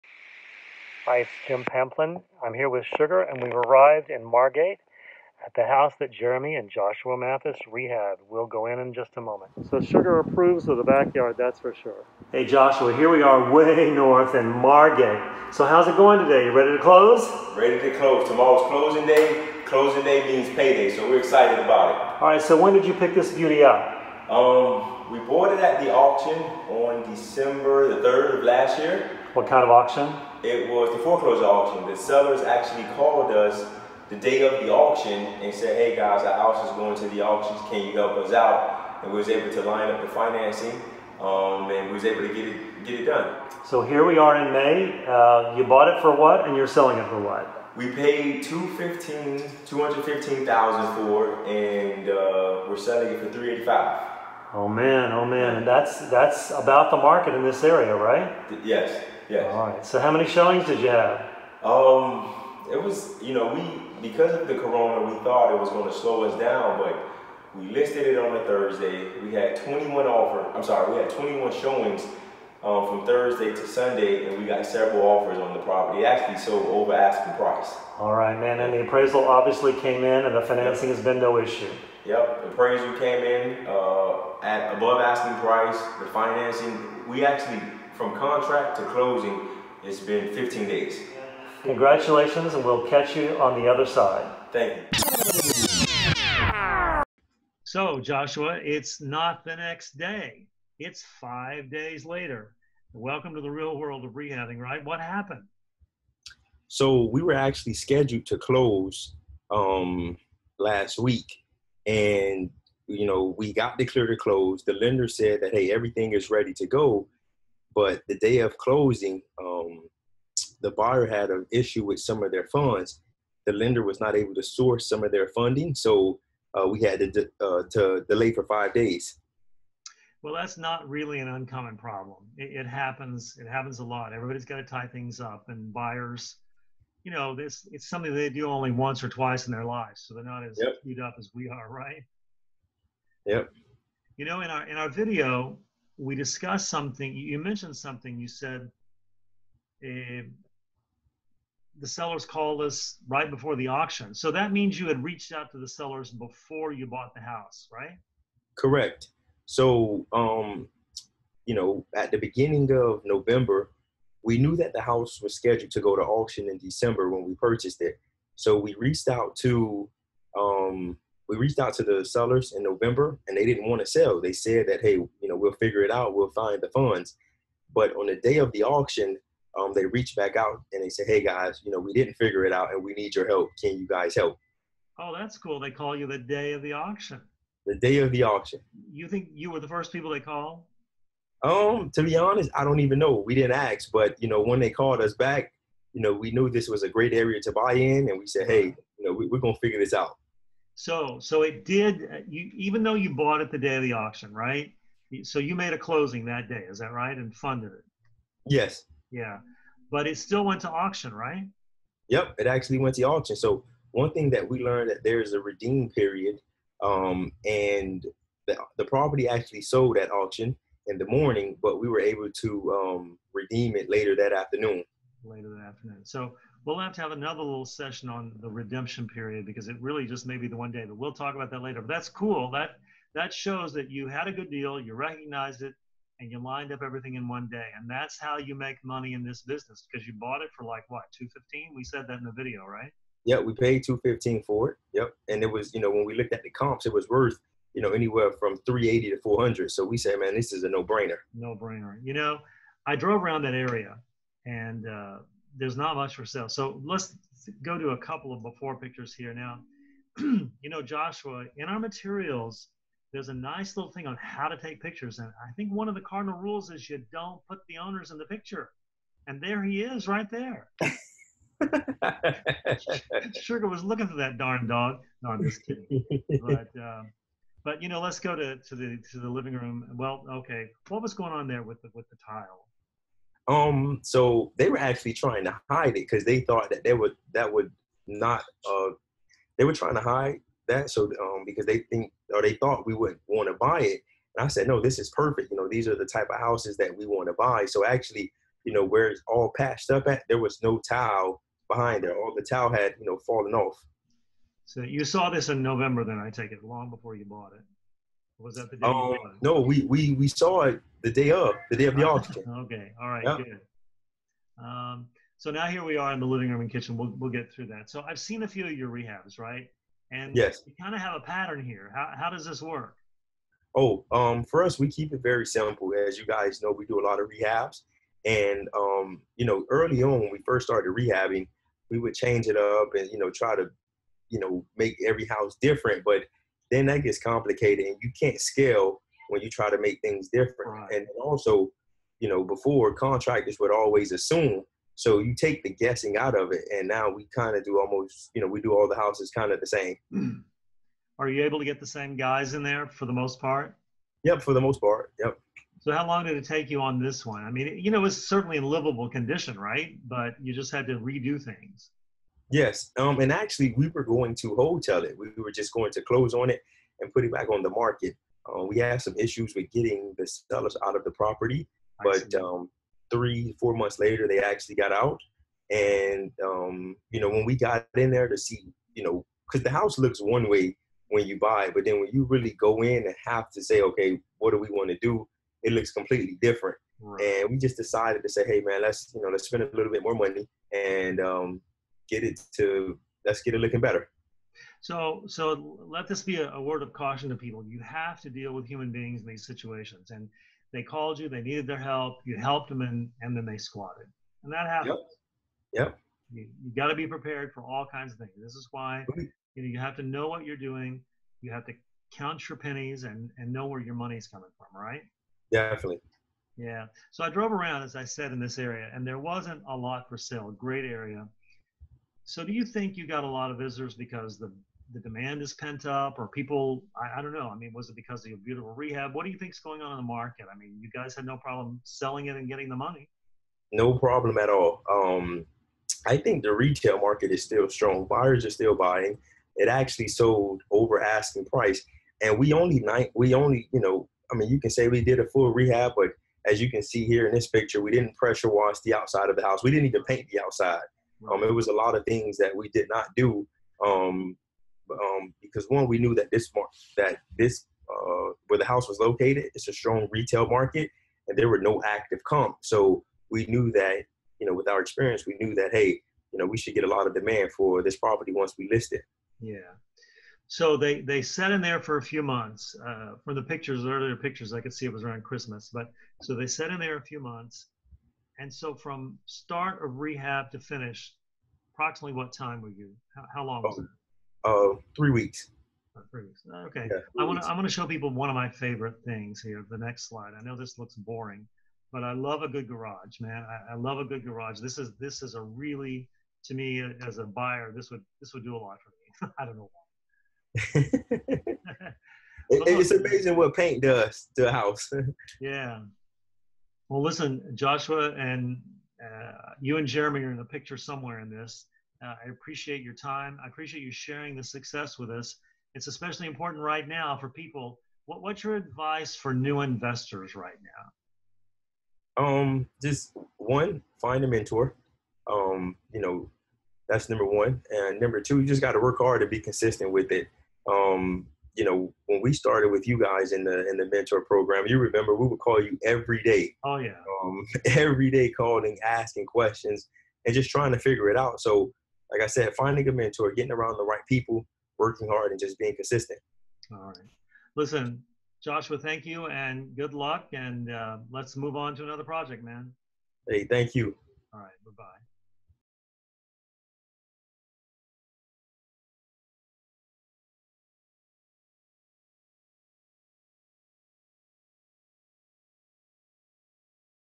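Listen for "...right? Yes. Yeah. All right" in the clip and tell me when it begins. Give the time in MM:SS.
00:57.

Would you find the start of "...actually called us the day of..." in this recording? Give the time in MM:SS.
00:32.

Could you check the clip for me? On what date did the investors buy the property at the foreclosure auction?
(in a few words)
December 3.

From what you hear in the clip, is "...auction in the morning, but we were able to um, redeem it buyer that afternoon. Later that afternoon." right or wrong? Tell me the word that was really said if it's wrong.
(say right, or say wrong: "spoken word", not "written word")
wrong: "later", not "buyer".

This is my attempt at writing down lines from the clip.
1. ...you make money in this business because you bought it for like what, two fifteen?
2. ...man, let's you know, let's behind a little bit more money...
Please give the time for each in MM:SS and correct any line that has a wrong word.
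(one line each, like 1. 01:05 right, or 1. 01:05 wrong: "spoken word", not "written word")
1. 03:58 right
2. 06:28 wrong: "spend", not "behind".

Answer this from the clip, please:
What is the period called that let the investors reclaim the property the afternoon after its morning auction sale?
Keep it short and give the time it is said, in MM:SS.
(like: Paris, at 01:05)
redeem period, at 03:35.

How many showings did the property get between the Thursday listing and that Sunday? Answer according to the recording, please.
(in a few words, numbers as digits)
21.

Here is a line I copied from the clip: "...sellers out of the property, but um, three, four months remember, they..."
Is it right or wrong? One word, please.
wrong.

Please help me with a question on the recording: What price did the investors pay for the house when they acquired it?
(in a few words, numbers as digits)
$215,000.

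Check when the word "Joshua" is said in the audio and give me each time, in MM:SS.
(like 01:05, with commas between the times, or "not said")
00:06, 00:12, 01:37, 04:20, 08:27, 09:08.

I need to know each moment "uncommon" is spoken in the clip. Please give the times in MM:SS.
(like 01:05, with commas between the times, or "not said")
02:11.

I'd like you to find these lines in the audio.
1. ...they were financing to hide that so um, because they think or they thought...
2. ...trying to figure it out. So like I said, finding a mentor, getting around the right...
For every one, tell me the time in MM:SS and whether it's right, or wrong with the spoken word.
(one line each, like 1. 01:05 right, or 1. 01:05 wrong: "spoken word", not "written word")
1. 04:49 wrong: "trying", not "financing"
2. 09:00 right.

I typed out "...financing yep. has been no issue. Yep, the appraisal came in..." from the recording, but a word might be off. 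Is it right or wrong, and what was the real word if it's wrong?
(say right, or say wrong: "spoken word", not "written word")
right.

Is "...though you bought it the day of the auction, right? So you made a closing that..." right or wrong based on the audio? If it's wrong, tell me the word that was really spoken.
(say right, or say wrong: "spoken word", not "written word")
right.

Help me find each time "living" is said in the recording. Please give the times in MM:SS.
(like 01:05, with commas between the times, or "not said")
04:39, 05:16.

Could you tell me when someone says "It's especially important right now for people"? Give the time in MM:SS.
08:35.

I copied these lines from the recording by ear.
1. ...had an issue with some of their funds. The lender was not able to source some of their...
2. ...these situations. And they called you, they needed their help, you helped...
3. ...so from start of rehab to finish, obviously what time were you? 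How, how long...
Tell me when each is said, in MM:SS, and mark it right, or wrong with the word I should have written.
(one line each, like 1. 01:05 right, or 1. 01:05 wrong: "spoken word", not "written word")
1. 02:01 right
2. 06:39 right
3. 07:58 wrong: "approximately", not "obviously".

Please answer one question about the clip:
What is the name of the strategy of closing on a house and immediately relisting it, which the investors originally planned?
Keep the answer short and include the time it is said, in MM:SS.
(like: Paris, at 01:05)
wholetail, at 06:04.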